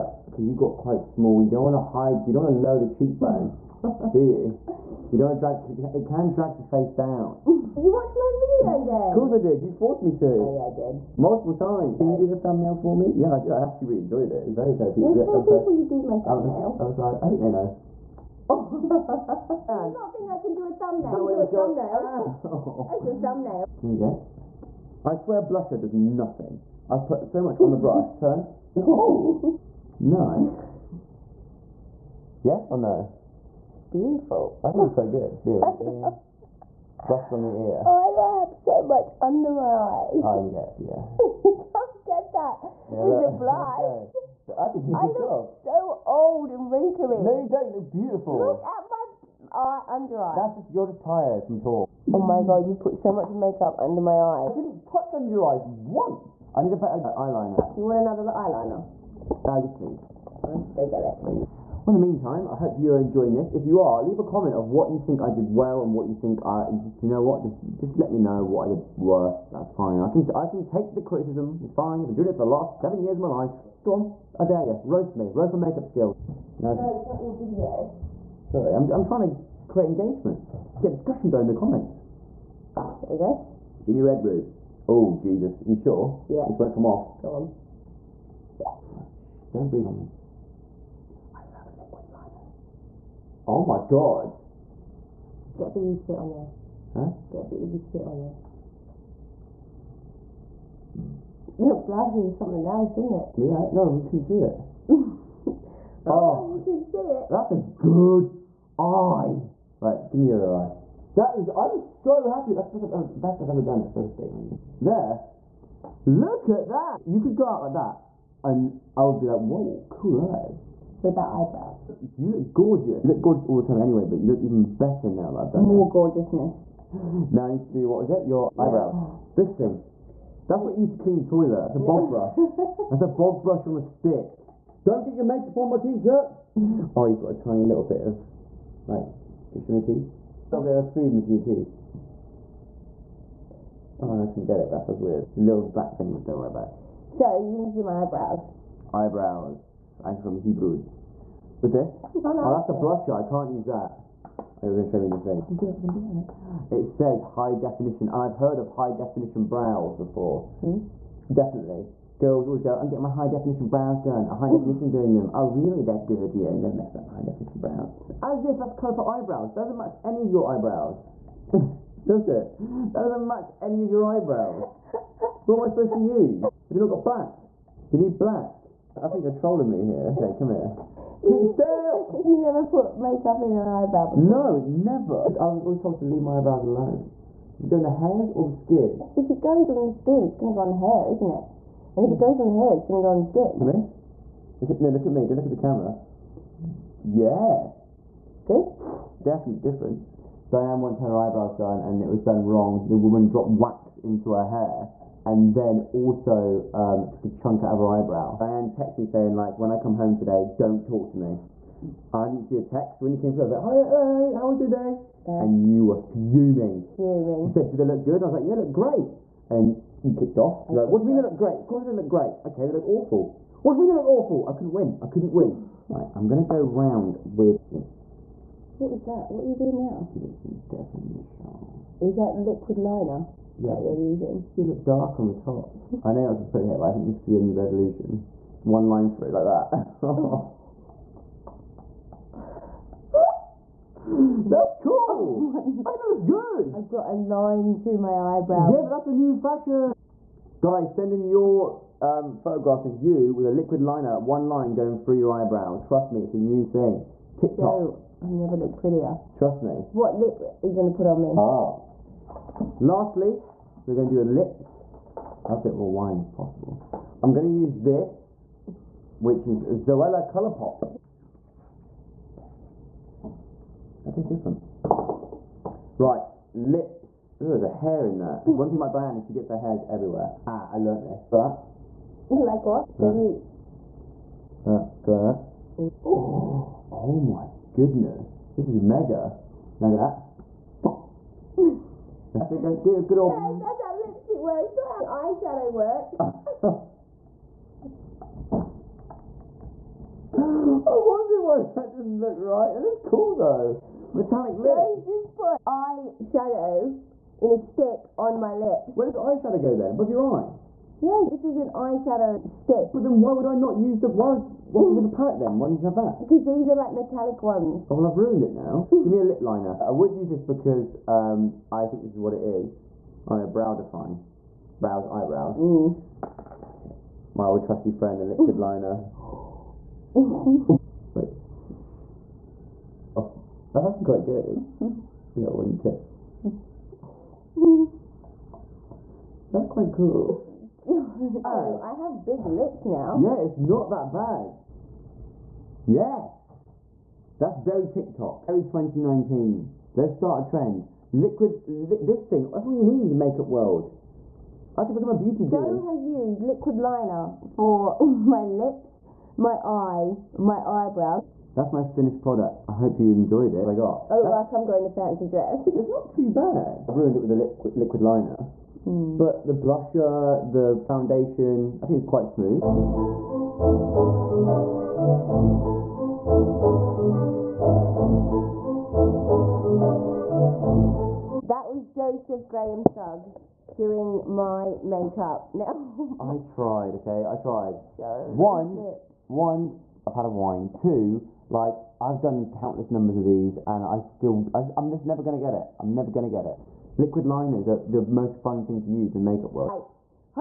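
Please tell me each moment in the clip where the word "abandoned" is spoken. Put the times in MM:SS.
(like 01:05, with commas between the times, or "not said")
not said.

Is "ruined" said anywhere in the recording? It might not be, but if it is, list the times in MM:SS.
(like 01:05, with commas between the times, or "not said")
05:18, 06:06.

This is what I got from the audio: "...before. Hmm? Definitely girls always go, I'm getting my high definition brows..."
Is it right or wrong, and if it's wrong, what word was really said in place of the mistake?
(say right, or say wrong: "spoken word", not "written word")
right.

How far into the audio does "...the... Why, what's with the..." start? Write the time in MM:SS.
05:14.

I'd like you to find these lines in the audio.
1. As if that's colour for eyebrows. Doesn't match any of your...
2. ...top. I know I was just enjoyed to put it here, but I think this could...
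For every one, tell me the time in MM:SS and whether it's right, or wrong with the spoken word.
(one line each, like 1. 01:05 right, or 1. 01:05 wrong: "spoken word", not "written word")
1. 02:48 right
2. 03:55 wrong: "supposed", not "enjoyed".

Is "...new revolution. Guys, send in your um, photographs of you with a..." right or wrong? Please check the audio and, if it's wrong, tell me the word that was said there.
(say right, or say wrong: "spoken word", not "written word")
wrong: "fashion", not "revolution".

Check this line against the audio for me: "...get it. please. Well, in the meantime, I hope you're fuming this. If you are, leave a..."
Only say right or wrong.
wrong.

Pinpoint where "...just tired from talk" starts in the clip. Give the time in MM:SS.
00:50.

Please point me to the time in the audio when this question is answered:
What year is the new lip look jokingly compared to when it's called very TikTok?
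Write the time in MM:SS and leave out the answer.
05:48.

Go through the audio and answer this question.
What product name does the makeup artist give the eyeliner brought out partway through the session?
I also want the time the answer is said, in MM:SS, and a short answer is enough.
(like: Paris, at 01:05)
Jimmy Redroot, at 01:23.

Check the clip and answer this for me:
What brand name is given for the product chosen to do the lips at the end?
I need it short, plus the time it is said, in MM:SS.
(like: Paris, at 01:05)
Zoella Colourpop, at 04:29.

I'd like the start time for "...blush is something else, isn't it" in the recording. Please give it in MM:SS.
01:41.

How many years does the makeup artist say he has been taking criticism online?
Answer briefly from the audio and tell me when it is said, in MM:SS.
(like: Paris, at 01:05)
7, at 01:12.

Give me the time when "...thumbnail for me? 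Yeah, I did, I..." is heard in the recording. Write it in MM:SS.
00:12.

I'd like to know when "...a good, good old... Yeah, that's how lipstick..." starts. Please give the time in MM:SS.
04:52.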